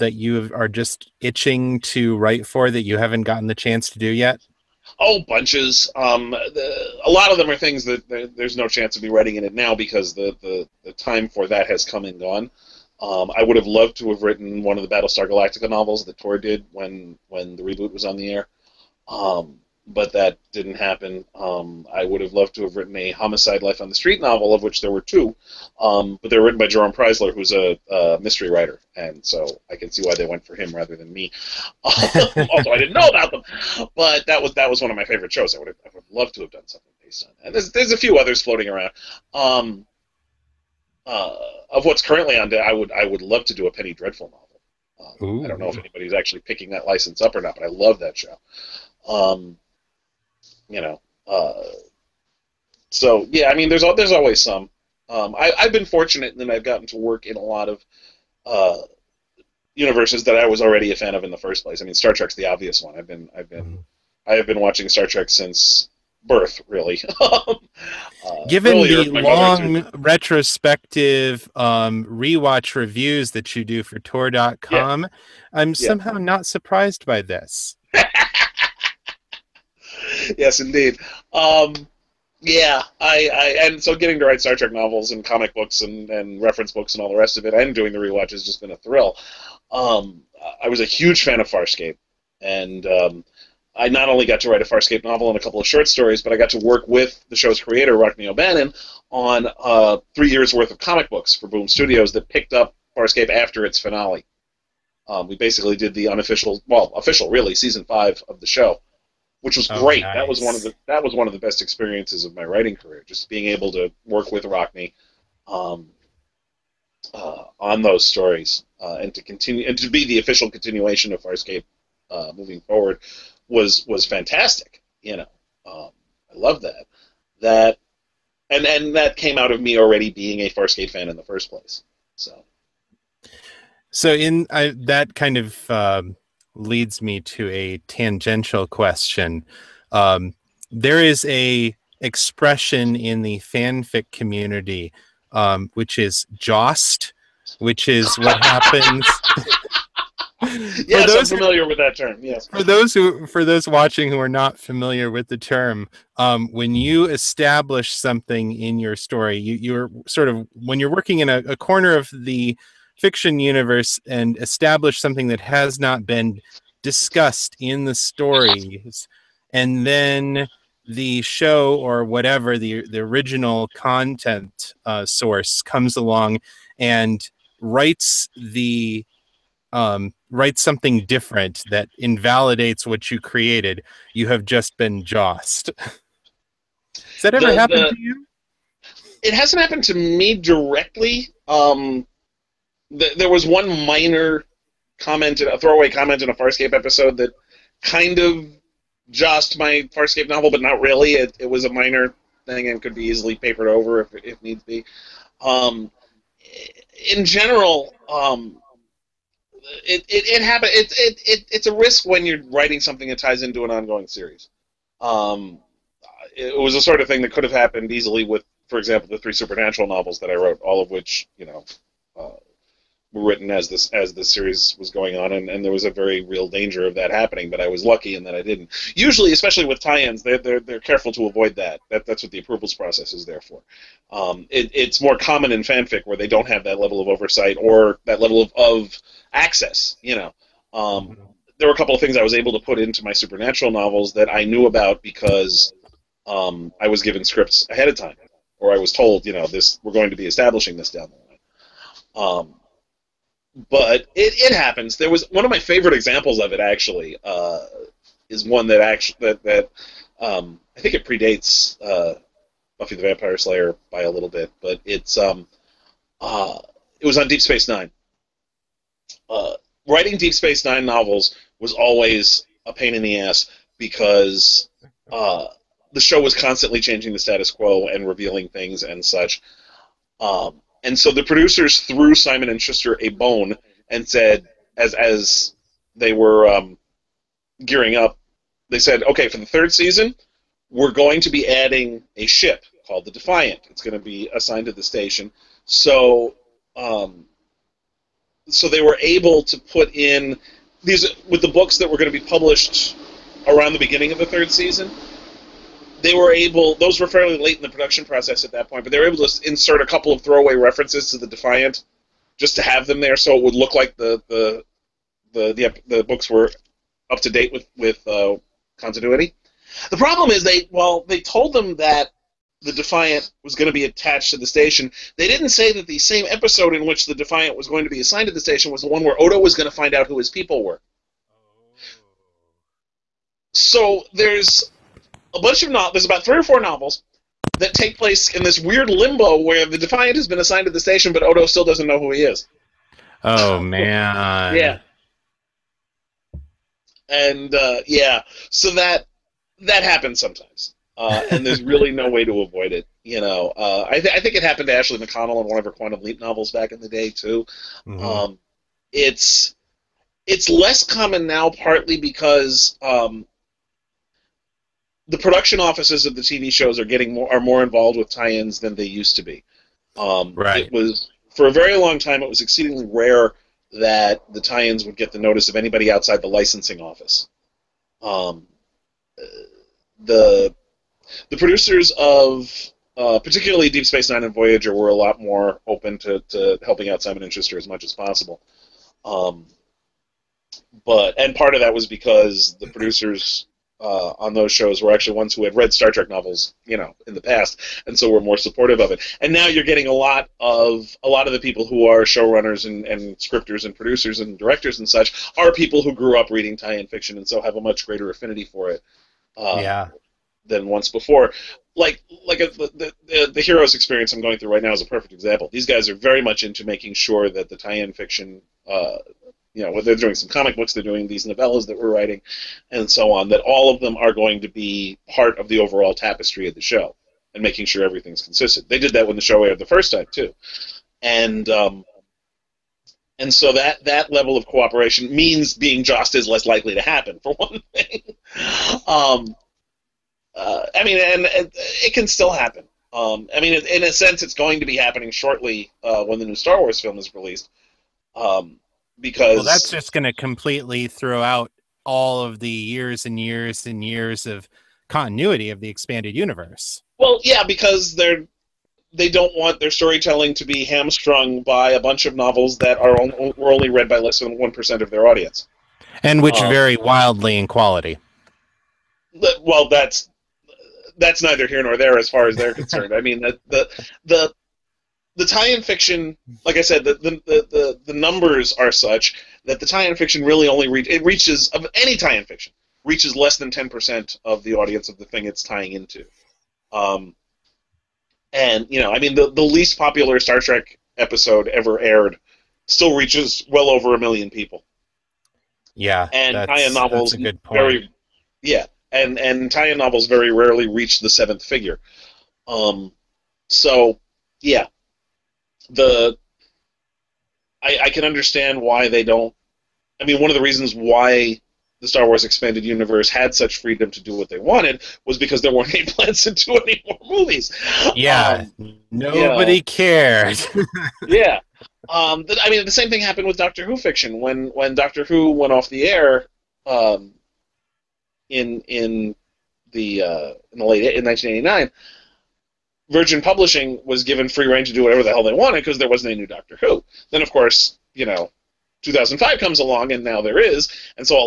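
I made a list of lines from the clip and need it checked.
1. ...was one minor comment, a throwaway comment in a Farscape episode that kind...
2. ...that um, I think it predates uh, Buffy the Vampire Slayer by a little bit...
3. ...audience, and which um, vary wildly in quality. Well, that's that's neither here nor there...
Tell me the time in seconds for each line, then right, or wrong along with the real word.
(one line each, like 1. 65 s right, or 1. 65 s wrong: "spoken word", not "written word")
1. 193 s right
2. 259 s right
3. 465 s right.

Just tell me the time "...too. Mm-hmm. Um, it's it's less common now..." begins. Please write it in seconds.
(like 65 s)
357 s.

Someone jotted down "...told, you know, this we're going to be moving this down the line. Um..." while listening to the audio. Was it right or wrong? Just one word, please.
wrong.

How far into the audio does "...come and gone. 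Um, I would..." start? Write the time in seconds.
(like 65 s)
11 s.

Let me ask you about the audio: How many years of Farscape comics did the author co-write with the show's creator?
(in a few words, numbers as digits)
3.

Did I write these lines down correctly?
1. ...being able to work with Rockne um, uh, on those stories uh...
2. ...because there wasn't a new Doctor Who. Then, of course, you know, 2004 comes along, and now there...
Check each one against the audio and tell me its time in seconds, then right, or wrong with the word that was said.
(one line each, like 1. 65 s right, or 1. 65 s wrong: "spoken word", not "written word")
1. 113 s right
2. 535 s wrong: "2005", not "2004".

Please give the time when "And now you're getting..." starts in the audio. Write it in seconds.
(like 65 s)
399 s.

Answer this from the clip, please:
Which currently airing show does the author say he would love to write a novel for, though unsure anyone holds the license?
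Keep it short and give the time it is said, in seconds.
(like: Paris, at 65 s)
Penny Dreadful, at 43 s.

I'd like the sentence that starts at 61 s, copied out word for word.
I mean, Star Trek's the obvious one.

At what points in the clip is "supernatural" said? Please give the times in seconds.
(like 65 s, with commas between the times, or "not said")
219 s, 243 s.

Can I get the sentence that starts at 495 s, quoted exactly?
Yeah, and tie-in novels very yeah, and and tie-in novels very rarely reach the seventh figure.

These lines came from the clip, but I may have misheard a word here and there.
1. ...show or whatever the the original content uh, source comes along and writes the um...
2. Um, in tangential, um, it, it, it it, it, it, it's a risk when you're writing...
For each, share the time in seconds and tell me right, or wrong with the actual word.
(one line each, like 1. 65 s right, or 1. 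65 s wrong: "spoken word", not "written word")
1. 171 s right
2. 205 s wrong: "general", not "tangential".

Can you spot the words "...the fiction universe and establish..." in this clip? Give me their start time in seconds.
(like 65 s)
162 s.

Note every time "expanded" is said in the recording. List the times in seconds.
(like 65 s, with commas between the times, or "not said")
455 s, 512 s.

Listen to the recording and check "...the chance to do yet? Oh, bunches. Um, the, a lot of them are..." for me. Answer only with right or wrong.
right.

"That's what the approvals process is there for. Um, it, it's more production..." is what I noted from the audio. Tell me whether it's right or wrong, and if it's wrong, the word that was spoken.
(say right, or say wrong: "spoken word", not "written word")
wrong: "common", not "production".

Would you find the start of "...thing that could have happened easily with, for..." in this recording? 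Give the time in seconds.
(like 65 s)
217 s.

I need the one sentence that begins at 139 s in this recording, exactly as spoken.
Um, there is a expression in the fanfic community, um, which is "jossed," which is what happens.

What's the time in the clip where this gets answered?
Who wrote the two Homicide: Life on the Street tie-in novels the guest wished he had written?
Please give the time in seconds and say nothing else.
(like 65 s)
26 s.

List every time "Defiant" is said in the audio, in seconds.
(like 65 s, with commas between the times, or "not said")
293 s, 311 s, 322 s, 327 s, 339 s.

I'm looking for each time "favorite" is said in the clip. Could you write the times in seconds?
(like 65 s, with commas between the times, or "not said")
35 s, 255 s.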